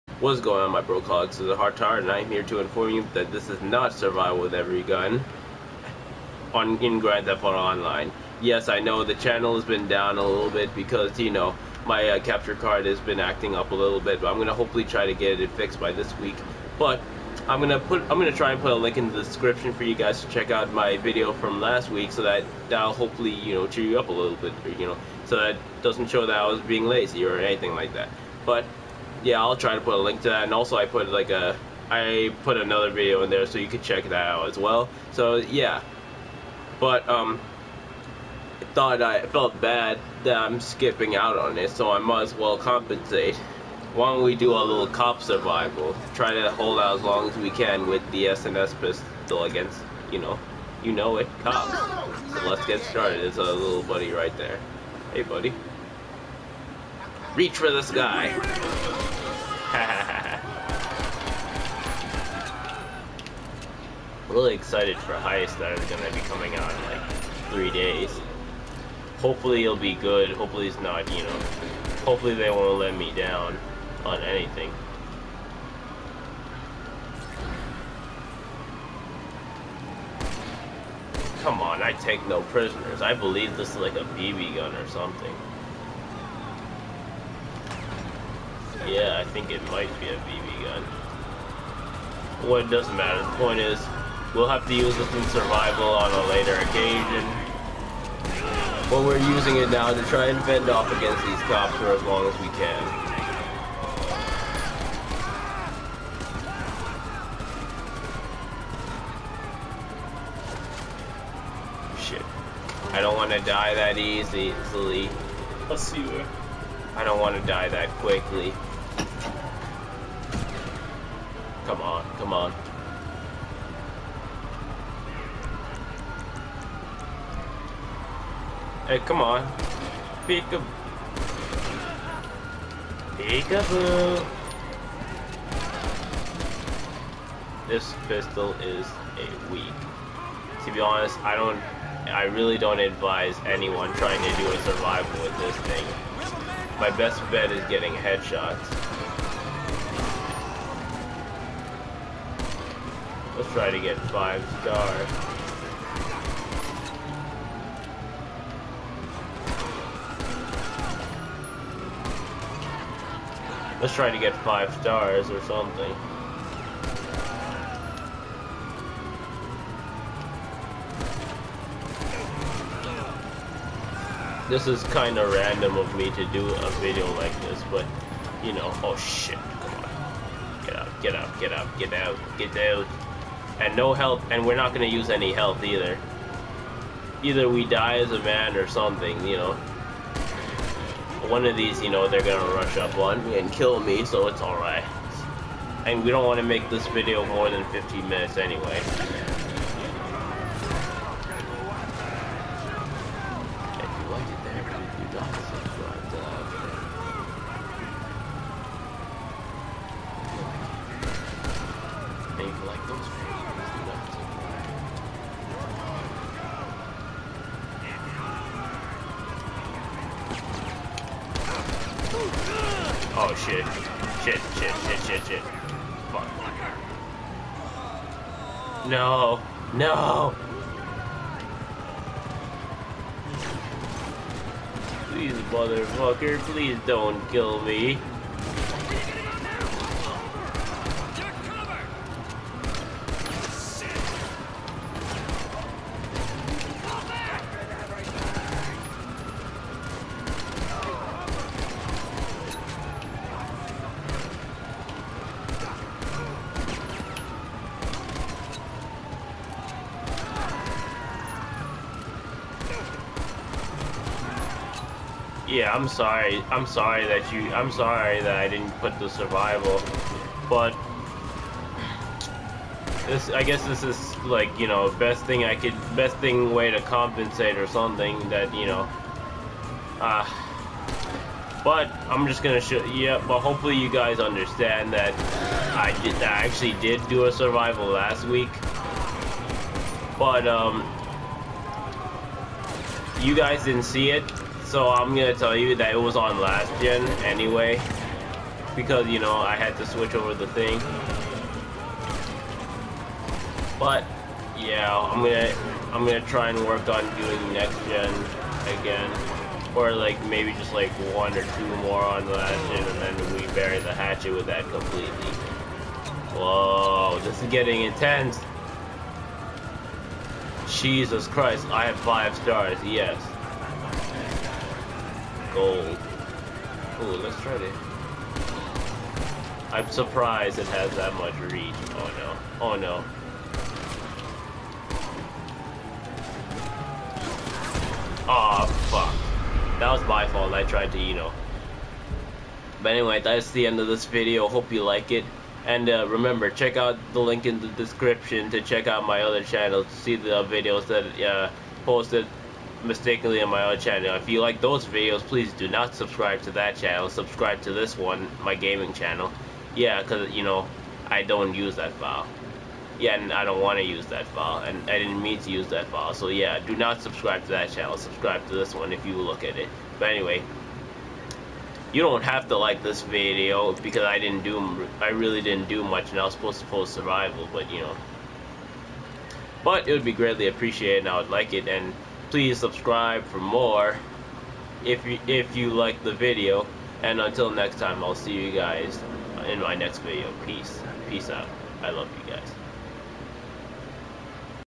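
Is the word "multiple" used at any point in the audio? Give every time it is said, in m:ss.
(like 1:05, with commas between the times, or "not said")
not said.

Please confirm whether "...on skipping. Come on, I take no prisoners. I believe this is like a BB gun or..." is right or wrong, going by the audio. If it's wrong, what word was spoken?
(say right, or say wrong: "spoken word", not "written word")
wrong: "anything", not "skipping".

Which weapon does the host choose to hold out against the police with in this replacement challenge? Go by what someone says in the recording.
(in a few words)
SNS pistol.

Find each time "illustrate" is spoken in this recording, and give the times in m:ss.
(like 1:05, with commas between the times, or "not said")
not said.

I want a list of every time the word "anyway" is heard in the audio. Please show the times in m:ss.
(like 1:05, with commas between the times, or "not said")
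3:18, 4:57, 5:42, 6:10.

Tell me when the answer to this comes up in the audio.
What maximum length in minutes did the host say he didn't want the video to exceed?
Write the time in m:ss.
3:17.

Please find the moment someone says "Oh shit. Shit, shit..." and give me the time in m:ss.
3:42.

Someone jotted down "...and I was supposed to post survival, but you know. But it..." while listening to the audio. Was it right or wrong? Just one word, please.
right.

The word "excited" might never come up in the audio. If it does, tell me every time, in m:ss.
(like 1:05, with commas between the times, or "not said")
1:04.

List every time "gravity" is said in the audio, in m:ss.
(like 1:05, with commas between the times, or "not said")
not said.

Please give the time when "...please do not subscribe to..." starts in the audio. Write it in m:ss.
5:55.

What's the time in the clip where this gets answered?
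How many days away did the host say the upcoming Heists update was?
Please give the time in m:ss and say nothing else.
1:07.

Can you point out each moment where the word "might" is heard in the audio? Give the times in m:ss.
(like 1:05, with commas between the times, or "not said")
0:41, 1:29.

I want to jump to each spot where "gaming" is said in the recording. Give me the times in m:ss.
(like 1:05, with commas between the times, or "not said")
5:58.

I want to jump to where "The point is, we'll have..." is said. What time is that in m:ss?
1:33.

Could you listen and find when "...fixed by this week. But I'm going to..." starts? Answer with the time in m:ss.
0:15.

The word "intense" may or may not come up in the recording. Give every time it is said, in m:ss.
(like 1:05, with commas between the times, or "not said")
5:17.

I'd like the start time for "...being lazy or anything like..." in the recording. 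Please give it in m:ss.
0:26.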